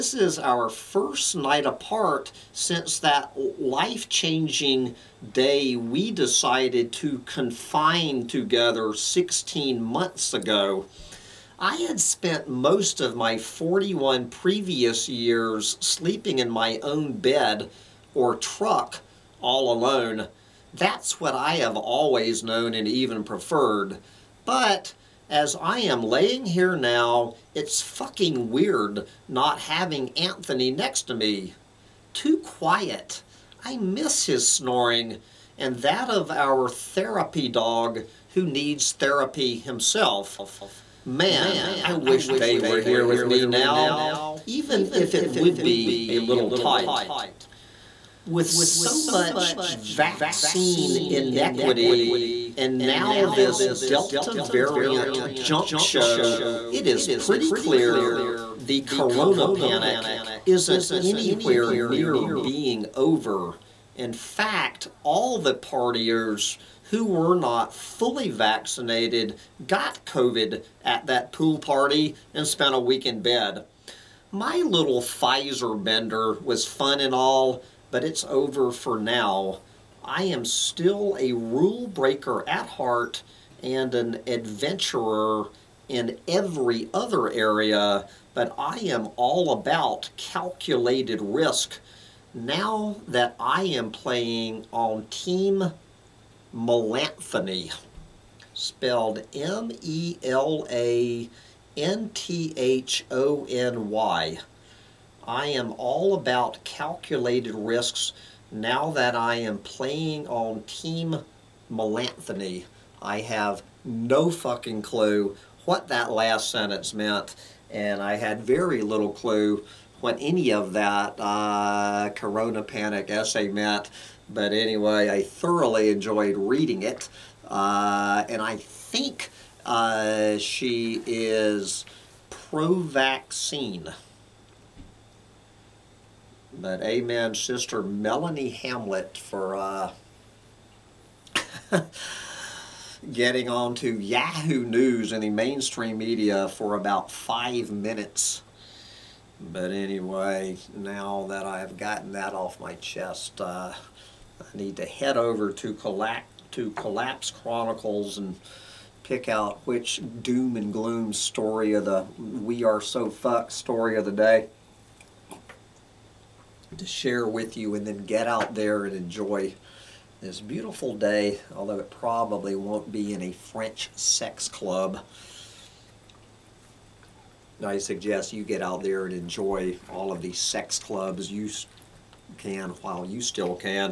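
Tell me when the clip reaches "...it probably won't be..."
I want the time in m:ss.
2:51.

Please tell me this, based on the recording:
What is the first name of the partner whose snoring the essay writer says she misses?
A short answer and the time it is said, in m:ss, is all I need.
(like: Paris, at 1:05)
Anthony, at 0:30.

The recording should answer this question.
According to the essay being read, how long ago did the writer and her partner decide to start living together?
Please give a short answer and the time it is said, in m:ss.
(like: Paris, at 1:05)
16 months, at 0:08.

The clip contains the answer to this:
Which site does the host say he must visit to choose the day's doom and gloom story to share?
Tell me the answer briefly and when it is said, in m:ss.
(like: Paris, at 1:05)
Collapse Chronicles, at 2:36.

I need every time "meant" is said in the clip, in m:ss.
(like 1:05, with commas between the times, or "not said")
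1:56, 2:03.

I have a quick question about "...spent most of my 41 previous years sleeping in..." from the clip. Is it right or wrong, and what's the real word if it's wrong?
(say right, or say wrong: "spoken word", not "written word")
right.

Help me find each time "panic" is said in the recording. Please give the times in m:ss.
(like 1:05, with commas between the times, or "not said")
0:59, 2:02.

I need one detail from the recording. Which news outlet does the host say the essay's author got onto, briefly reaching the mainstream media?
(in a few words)
Yahoo News.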